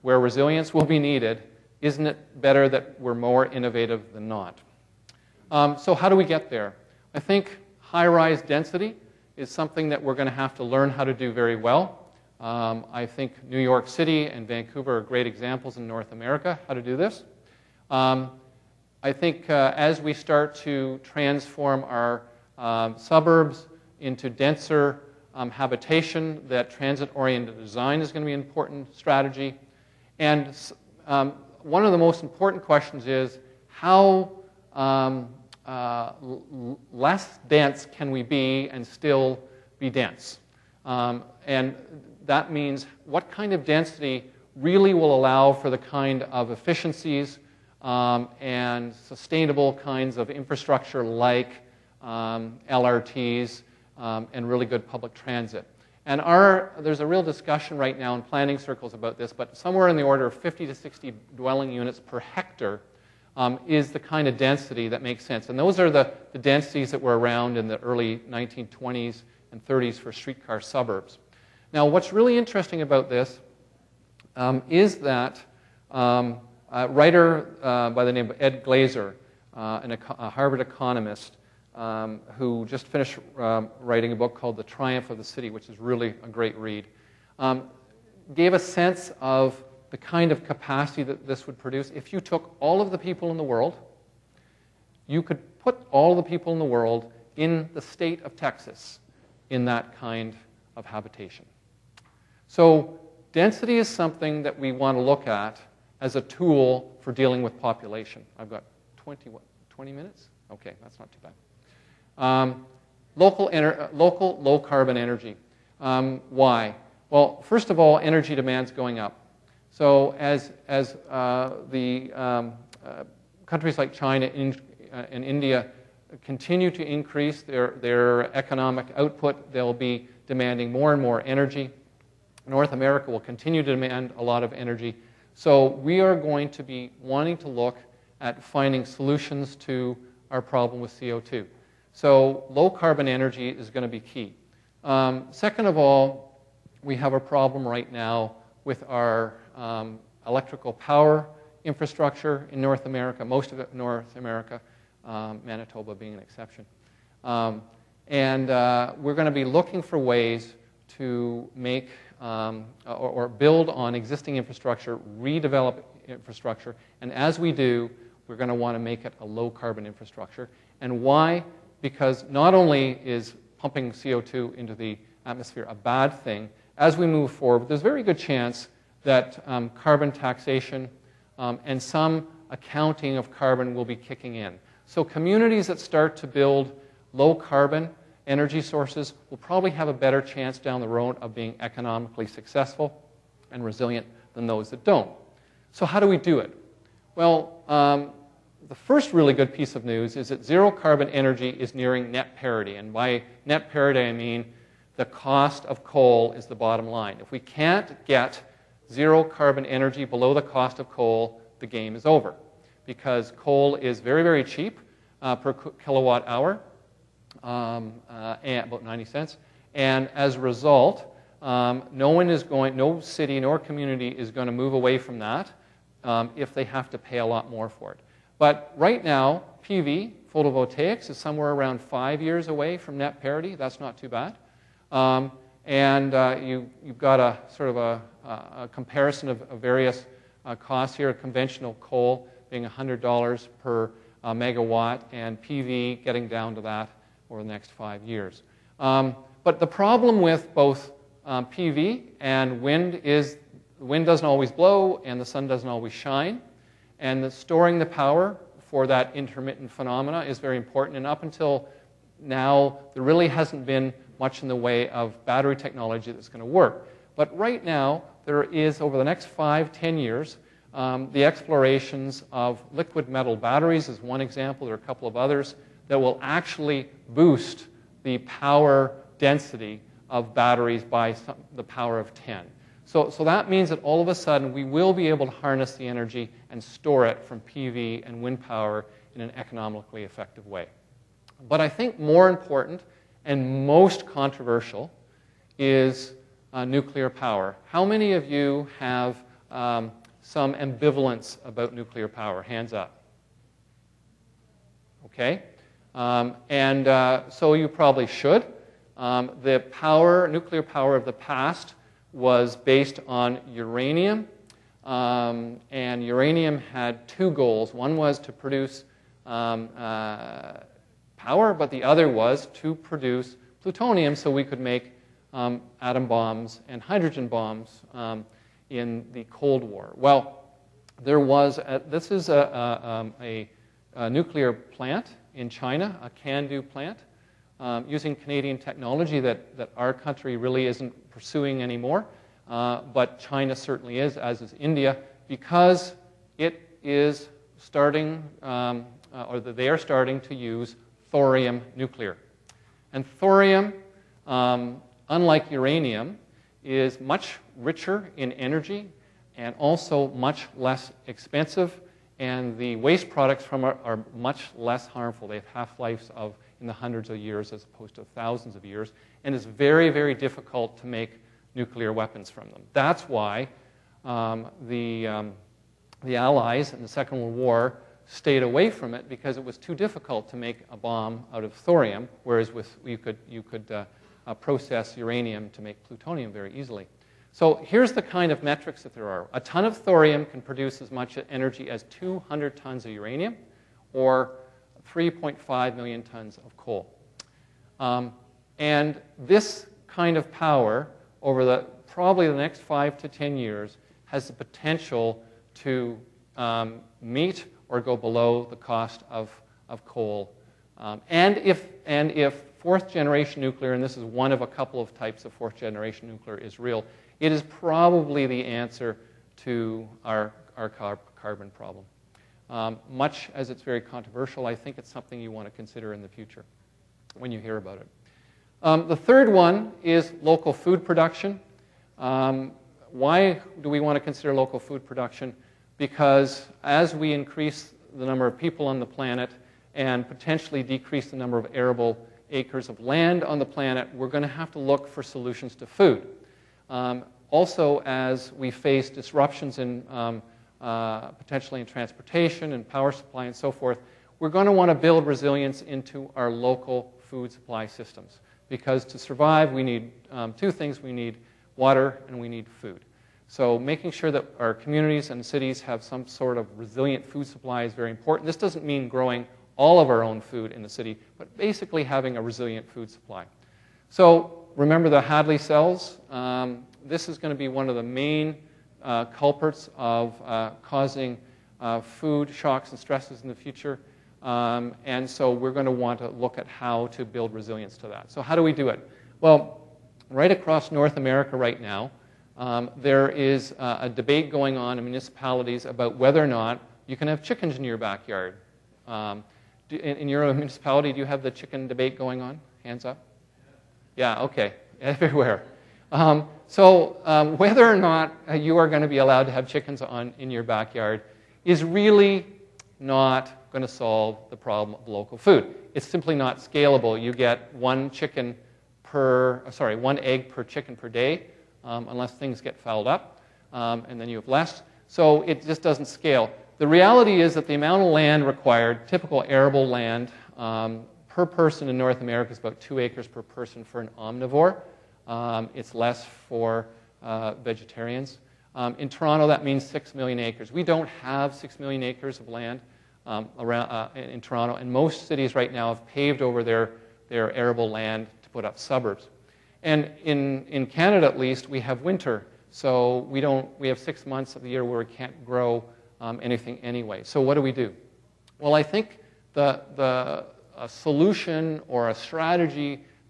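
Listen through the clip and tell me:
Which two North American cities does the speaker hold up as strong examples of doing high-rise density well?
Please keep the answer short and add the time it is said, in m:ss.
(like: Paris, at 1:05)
New York City and Vancouver, at 0:13.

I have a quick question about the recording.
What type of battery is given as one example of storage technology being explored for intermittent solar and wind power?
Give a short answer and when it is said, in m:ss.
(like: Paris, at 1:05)
Liquid metal batteries, at 4:32.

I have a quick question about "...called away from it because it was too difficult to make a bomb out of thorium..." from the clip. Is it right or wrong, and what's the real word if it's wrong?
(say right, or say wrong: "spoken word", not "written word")
wrong: "stayed", not "called".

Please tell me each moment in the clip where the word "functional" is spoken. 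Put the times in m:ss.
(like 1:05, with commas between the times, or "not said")
not said.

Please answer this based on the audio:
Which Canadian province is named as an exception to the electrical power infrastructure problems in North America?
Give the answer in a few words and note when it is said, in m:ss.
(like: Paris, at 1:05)
Manitoba, at 2:35.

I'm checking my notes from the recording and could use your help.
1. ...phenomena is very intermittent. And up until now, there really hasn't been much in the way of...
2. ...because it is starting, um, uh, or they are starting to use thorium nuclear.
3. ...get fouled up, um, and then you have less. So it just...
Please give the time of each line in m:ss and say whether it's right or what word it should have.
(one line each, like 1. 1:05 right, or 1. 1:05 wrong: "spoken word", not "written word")
1. 4:19 wrong: "important", not "intermittent"
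2. 5:45 right
3. 8:42 right.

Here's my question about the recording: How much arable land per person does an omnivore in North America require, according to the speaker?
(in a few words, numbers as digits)
2 acres.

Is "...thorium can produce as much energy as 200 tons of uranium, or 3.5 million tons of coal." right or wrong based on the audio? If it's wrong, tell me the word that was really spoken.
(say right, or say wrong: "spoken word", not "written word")
right.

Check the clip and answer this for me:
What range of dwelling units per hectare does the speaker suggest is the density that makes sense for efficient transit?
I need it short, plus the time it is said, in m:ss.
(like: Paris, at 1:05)
50 to 60, at 1:00.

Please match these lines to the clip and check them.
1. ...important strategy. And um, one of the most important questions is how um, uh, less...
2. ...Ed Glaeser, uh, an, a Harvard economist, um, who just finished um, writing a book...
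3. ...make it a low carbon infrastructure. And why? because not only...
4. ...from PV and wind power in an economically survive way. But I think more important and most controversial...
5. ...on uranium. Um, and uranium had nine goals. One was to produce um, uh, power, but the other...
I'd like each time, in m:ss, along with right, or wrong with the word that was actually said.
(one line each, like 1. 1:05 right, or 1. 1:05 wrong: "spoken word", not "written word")
1. 0:28 right
2. 1:18 right
3. 2:48 right
4. 4:47 wrong: "effective", not "survive"
5. 5:13 wrong: "two", not "nine".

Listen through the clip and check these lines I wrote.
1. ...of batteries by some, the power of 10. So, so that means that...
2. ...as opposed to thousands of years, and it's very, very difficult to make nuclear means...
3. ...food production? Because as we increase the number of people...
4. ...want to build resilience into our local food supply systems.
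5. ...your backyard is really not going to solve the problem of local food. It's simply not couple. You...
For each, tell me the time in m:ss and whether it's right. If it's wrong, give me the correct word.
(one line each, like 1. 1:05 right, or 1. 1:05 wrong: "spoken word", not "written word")
1. 4:40 right
2. 6:07 wrong: "weapons", not "means"
3. 7:14 right
4. 7:34 right
5. 8:30 wrong: "scalable", not "couple".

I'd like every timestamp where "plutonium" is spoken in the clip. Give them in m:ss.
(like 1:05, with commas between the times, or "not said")
5:23, 6:25.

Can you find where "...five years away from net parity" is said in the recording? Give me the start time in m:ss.
3:51.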